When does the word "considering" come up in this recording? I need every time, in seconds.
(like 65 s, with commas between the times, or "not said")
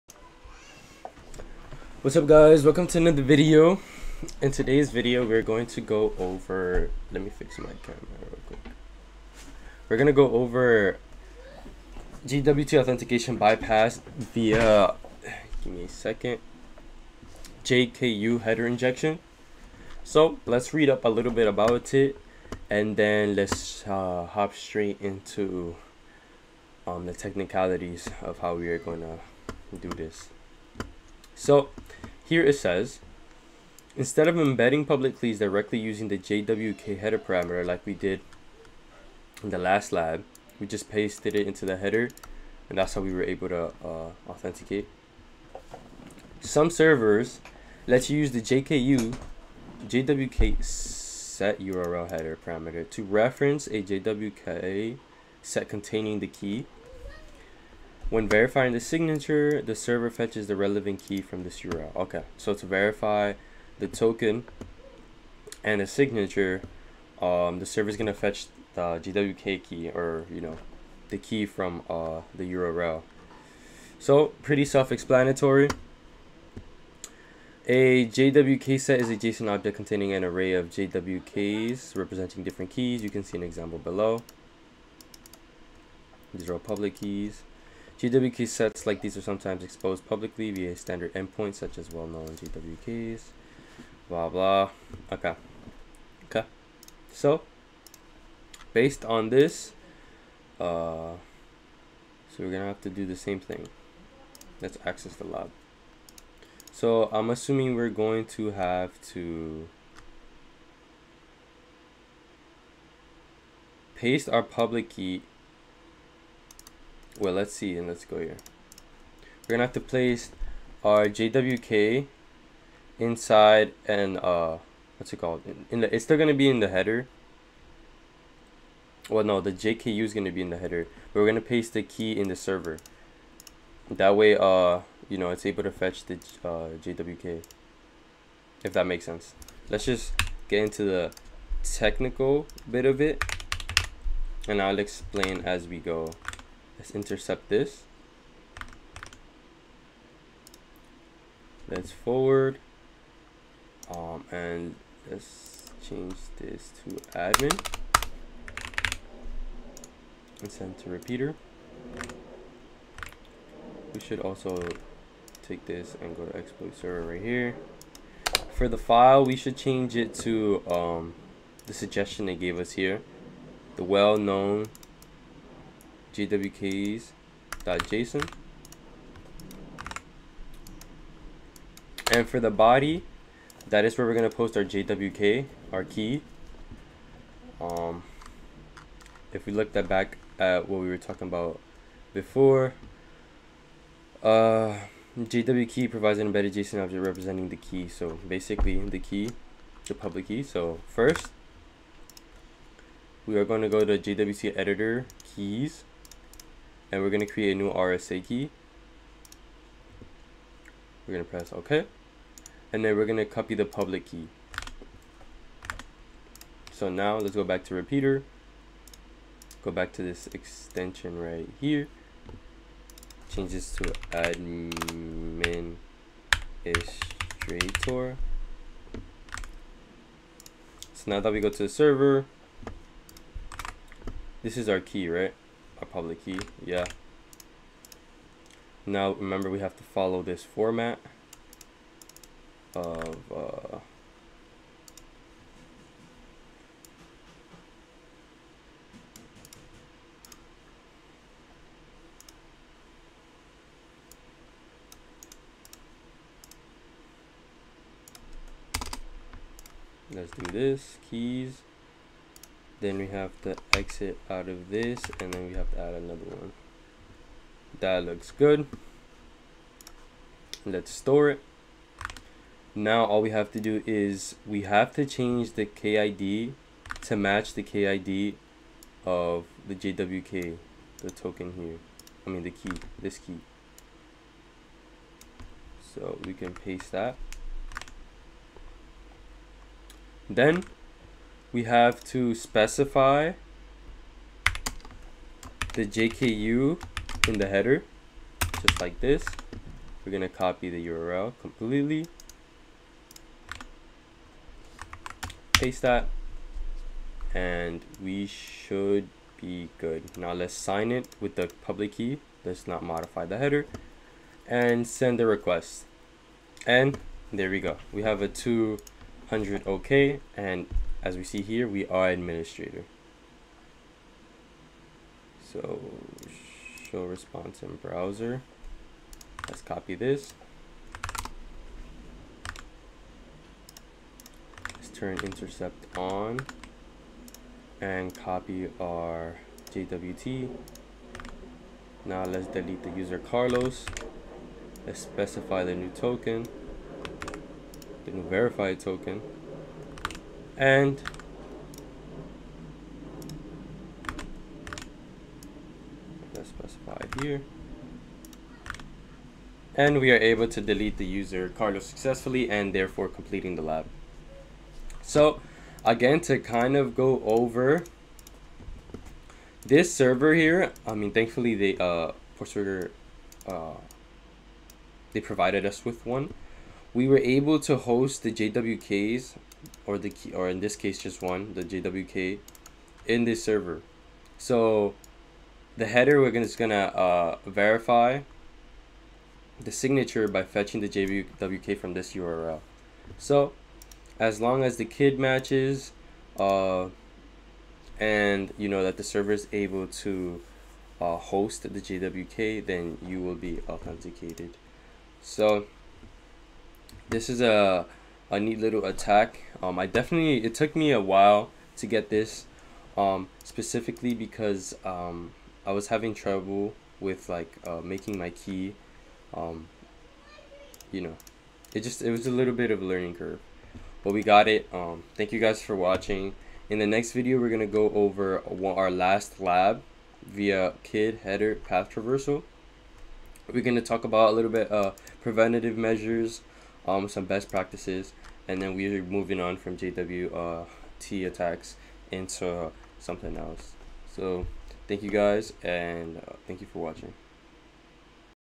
not said.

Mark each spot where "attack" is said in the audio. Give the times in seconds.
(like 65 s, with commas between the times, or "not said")
408 s, 441 s.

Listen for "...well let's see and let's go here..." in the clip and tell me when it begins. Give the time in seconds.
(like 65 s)
117 s.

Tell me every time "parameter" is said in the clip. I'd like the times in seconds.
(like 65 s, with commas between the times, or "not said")
37 s, 52 s.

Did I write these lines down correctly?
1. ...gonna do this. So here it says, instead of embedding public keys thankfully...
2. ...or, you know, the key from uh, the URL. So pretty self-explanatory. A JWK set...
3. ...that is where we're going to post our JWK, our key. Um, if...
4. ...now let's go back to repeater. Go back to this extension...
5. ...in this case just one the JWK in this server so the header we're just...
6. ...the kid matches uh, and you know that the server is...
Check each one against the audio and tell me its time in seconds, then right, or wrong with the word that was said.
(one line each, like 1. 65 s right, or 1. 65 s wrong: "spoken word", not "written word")
1. 28 s wrong: "directly", not "thankfully"
2. 69 s right
3. 183 s right
4. 216 s right
5. 380 s right
6. 394 s right.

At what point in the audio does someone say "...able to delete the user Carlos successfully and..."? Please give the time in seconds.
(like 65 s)
360 s.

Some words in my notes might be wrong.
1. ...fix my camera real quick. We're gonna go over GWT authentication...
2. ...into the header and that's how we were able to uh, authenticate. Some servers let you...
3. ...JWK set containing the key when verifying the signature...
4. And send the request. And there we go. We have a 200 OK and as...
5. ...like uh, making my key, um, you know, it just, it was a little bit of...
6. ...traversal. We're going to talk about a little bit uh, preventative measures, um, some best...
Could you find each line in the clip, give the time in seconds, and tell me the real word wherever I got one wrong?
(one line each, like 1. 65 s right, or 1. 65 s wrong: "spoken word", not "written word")
1. 7 s right
2. 41 s right
3. 53 s right
4. 314 s right
5. 417 s right
6. 431 s right.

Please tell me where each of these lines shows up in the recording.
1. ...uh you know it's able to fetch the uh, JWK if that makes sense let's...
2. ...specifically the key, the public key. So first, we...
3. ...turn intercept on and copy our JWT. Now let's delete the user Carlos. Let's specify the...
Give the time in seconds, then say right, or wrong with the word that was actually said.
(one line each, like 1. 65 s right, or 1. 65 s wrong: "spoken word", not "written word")
1. 134 s right
2. 198 s wrong: "basically", not "specifically"
3. 334 s right.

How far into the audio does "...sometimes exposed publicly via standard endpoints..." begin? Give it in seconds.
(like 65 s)
89 s.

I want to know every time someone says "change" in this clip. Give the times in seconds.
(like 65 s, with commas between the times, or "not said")
155 s, 169 s, 223 s, 275 s.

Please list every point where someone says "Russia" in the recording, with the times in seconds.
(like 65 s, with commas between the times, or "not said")
not said.